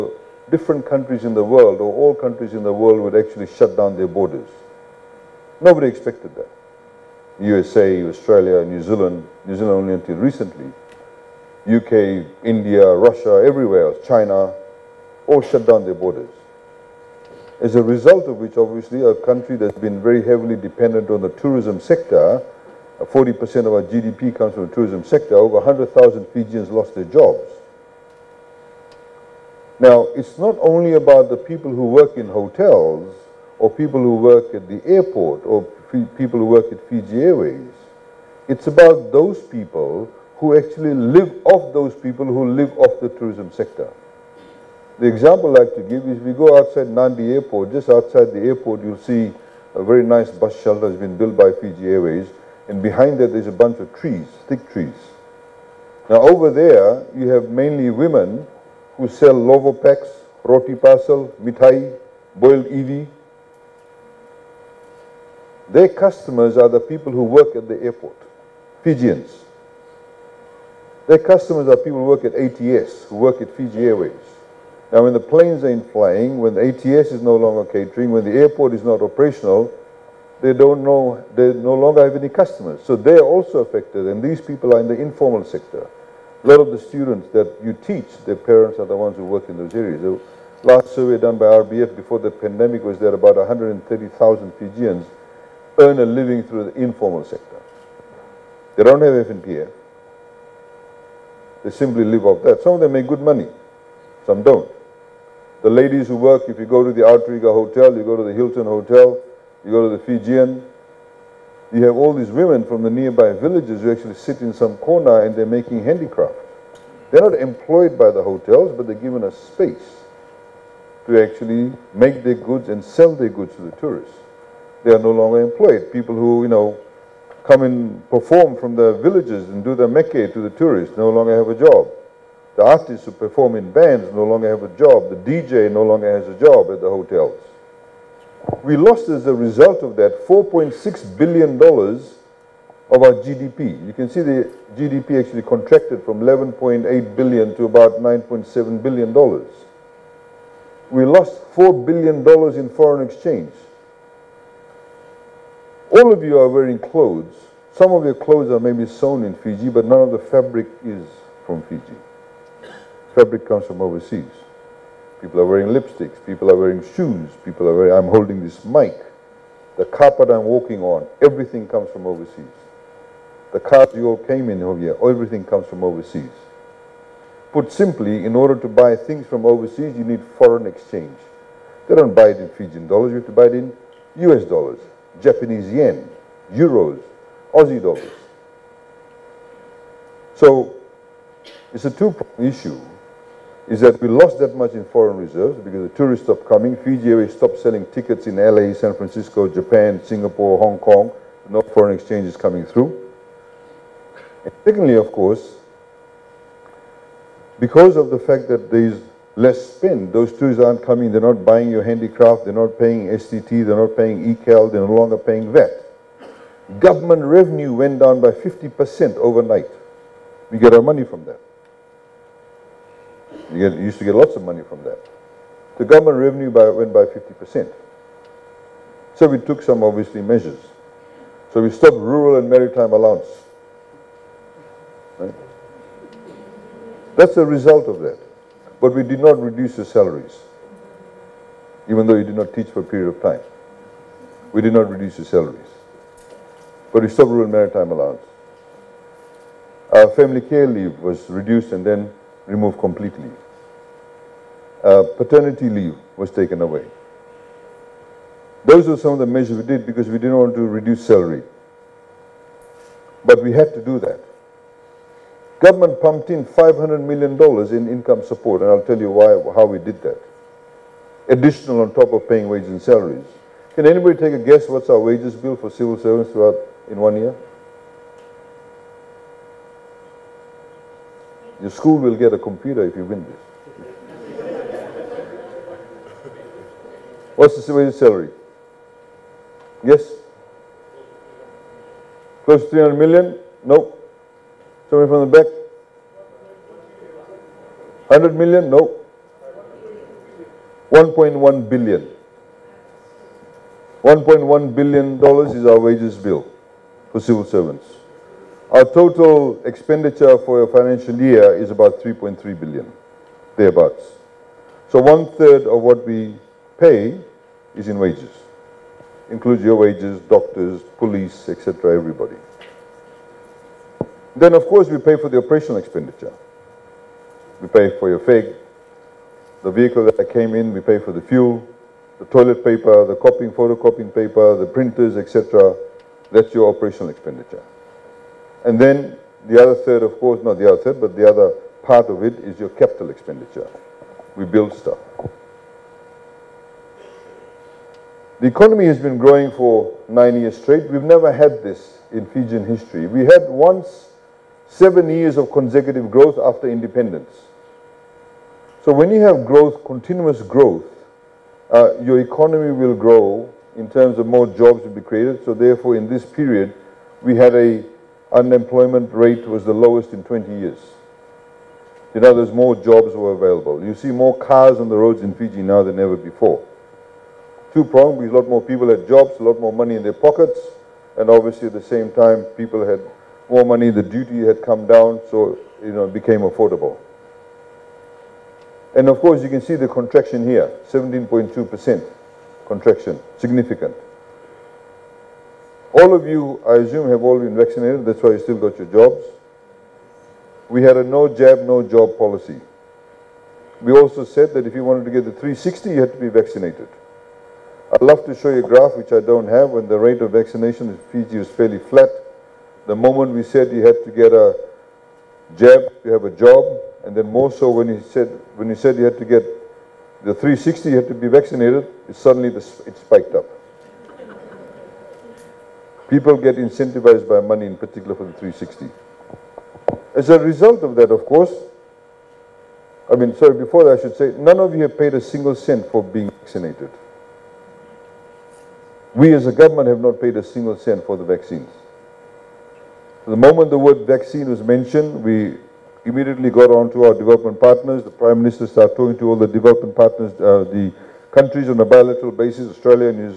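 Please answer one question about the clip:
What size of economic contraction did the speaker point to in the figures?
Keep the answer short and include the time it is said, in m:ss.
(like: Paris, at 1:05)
17.2%, at 6:30.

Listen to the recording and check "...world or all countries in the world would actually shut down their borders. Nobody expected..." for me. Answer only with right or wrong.
right.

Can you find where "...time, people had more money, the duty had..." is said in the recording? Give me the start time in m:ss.
6:22.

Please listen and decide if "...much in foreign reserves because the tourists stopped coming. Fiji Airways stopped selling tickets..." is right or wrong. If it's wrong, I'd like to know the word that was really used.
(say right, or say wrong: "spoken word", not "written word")
right.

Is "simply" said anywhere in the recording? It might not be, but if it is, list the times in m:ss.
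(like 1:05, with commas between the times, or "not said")
1:41, 2:57.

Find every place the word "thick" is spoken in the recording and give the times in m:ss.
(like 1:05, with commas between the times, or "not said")
0:54.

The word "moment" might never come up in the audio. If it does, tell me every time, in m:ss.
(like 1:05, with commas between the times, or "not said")
6:52, 7:23.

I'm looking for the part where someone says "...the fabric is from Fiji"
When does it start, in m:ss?
2:40.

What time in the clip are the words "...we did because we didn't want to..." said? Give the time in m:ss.
4:19.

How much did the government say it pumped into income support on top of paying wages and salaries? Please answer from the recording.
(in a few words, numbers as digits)
$500 million.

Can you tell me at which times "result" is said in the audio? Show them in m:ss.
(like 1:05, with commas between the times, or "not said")
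0:17, 2:19, 3:57, 7:10.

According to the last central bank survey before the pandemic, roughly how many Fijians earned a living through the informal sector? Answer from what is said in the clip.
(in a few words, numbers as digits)
130,000.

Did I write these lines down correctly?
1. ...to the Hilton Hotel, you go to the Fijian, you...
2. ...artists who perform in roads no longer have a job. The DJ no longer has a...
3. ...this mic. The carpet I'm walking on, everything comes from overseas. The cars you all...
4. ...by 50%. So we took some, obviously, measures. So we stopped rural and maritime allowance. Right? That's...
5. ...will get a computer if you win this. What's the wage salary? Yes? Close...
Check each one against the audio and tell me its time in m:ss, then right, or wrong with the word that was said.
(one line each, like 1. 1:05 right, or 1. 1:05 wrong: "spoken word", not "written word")
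1. 1:48 right
2. 2:12 wrong: "bands", not "roads"
3. 2:48 right
4. 3:46 right
5. 4:41 right.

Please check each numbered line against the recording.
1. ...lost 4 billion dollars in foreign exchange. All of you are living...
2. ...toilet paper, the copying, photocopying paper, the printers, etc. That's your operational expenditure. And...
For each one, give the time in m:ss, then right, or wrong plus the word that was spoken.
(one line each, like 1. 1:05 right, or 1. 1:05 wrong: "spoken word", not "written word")
1. 2:31 wrong: "wearing", not "living"
2. 5:32 right.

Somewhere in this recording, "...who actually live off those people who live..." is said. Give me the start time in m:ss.
0:40.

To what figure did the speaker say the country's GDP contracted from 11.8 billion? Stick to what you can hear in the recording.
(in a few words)
9.7 billion dollars.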